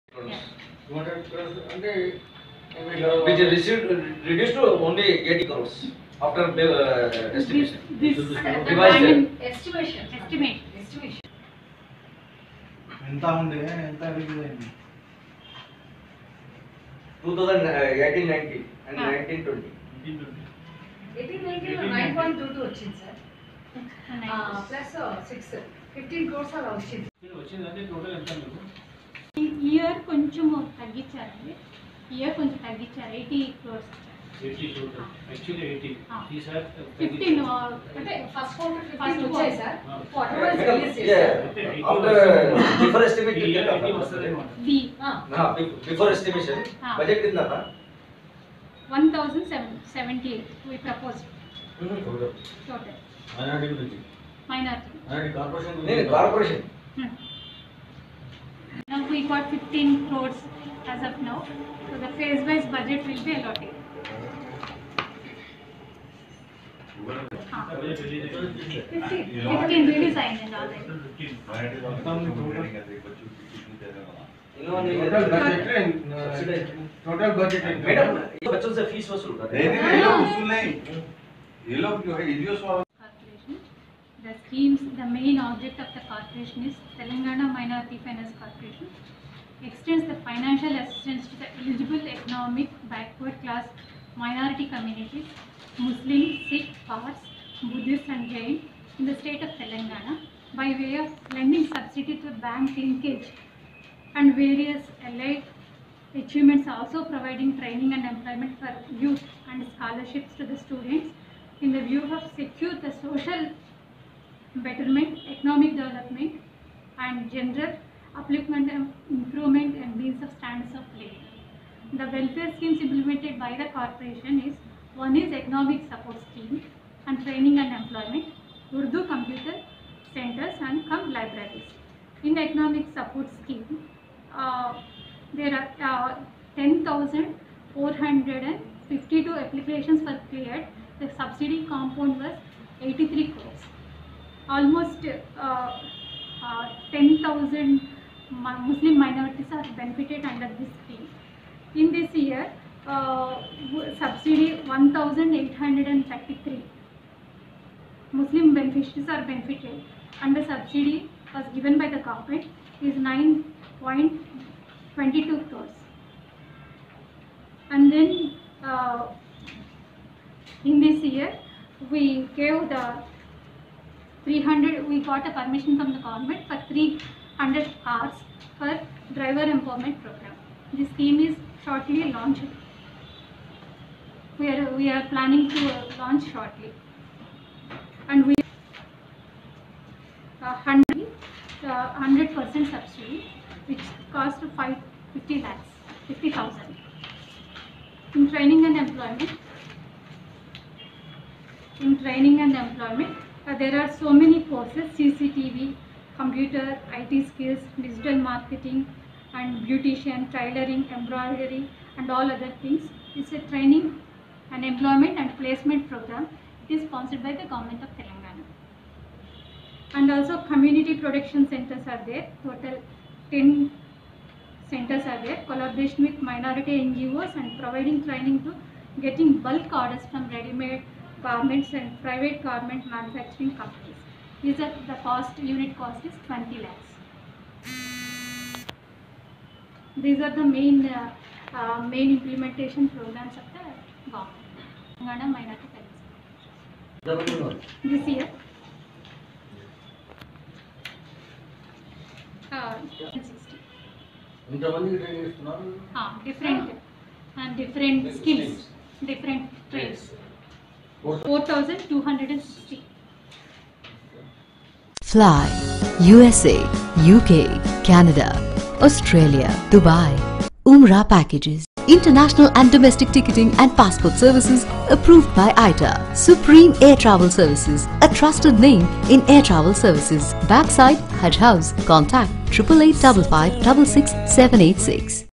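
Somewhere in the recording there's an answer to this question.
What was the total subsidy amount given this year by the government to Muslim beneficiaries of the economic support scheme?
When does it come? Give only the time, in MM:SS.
02:42.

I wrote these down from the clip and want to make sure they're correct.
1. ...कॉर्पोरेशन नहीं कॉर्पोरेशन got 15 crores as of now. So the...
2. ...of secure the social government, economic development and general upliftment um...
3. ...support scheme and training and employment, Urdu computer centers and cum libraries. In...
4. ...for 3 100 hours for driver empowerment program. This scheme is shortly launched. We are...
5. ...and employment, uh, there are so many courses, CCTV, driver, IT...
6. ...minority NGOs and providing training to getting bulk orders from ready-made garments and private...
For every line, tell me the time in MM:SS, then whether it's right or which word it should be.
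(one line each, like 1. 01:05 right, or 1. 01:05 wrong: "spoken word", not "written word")
1. 00:55 right
2. 01:52 wrong: "betterment", not "government"
3. 02:05 right
4. 02:56 right
5. 03:22 wrong: "computer", not "driver"
6. 03:46 right.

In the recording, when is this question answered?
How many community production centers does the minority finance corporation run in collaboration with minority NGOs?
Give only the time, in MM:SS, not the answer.
03:42.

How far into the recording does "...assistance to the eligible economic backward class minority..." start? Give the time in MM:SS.
01:30.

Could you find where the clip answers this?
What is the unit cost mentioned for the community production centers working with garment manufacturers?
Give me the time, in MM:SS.
03:56.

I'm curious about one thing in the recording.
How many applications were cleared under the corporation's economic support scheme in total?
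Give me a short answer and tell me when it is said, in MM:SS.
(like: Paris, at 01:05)
10,452, at 02:16.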